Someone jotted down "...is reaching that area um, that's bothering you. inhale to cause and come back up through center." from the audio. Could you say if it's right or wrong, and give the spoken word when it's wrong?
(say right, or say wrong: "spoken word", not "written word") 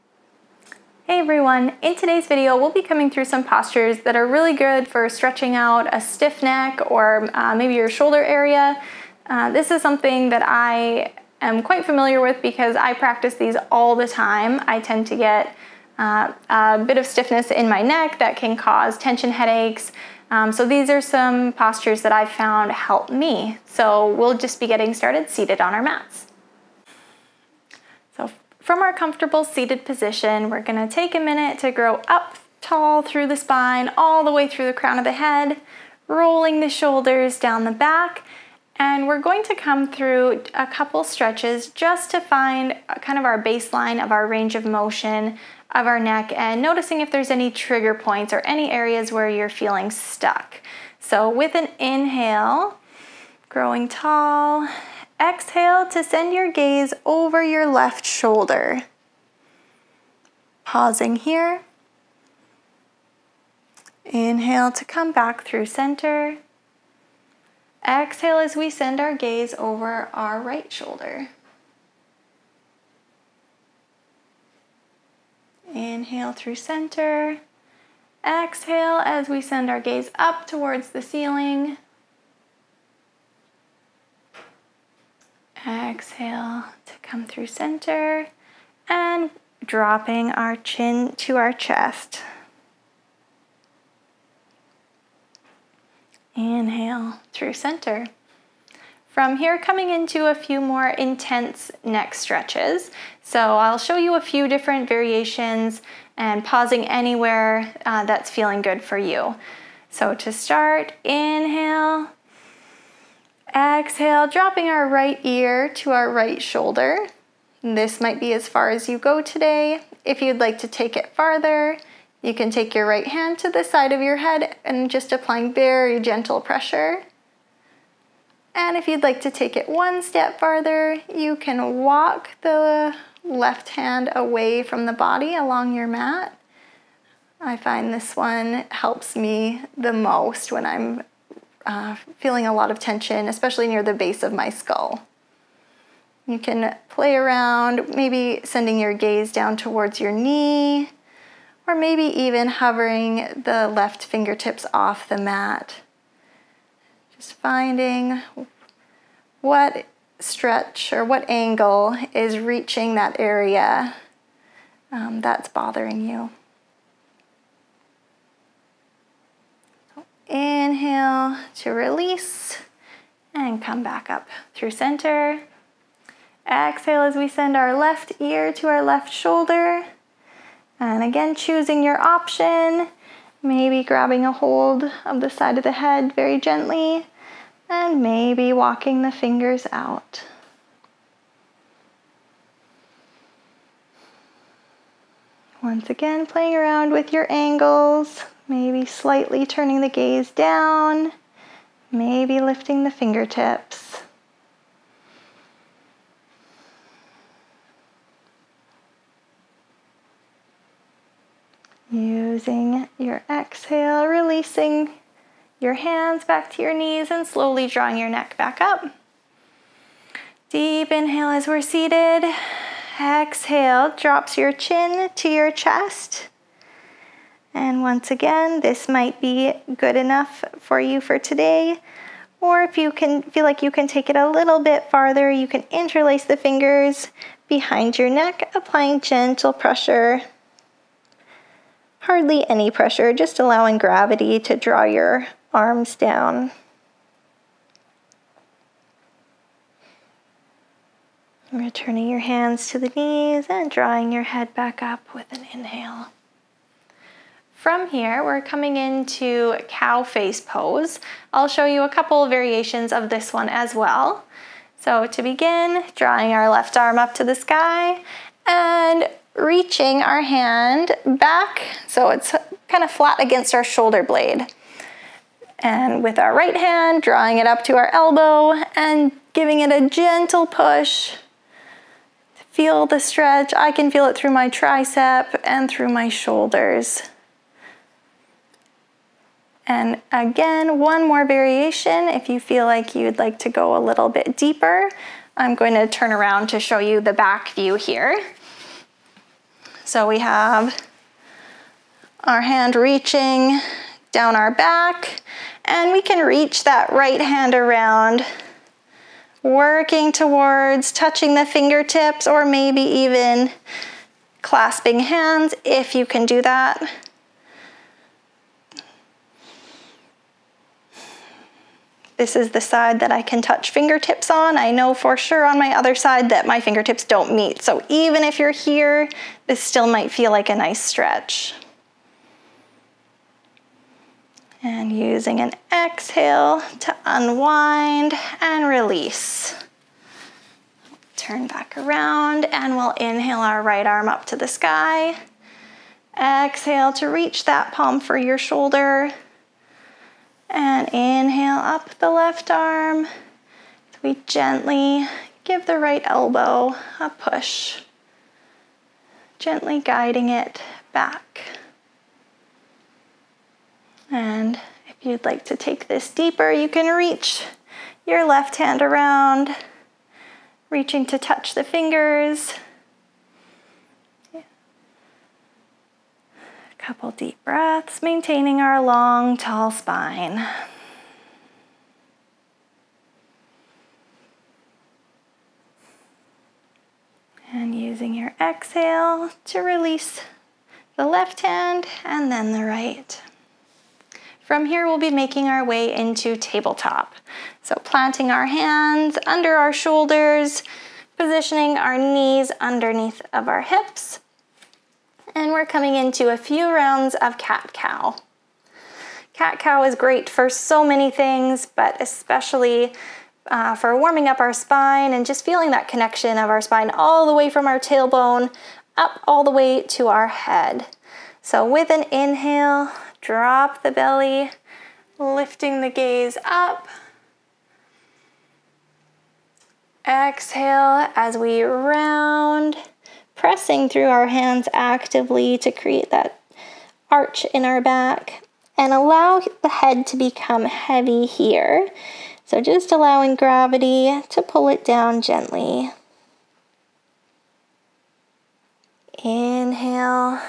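wrong: "release", not "cause".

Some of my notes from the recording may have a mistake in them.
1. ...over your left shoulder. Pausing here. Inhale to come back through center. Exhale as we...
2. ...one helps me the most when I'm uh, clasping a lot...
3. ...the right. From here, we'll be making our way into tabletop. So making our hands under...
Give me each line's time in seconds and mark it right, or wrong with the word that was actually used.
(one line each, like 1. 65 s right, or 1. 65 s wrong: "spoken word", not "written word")
1. 57 s right
2. 138 s wrong: "feeling", not "clasping"
3. 392 s wrong: "planting", not "making".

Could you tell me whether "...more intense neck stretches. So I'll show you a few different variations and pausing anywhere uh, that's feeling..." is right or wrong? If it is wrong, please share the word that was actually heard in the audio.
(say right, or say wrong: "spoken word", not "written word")
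right.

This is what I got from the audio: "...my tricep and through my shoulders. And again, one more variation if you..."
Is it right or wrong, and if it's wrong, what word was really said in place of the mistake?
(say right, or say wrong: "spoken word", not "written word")
right.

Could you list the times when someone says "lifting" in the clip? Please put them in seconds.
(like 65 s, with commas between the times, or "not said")
202 s, 425 s.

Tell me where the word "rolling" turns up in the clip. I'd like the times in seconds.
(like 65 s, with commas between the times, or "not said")
36 s.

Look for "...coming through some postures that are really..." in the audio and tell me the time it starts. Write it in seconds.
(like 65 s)
2 s.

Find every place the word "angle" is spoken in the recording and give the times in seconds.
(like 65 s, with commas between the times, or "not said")
161 s, 197 s.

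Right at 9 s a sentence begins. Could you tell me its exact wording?
Uh, this is something that I am quite familiar with because I practice these all the time.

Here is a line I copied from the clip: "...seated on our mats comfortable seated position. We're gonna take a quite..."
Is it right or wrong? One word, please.
wrong.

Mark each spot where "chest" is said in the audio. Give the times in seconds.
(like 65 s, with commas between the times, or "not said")
91 s, 225 s.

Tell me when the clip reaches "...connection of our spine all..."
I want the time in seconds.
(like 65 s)
415 s.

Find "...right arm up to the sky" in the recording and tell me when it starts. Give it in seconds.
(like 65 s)
343 s.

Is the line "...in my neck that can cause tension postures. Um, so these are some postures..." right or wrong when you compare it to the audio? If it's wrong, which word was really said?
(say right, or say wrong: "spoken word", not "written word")
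wrong: "headaches", not "postures".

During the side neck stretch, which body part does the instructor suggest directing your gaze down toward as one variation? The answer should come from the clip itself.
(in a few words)
knee.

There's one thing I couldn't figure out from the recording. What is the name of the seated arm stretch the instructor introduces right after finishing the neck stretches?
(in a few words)
cow face pose.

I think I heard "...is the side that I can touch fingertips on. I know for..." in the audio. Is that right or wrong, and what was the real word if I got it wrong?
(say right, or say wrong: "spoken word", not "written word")
right.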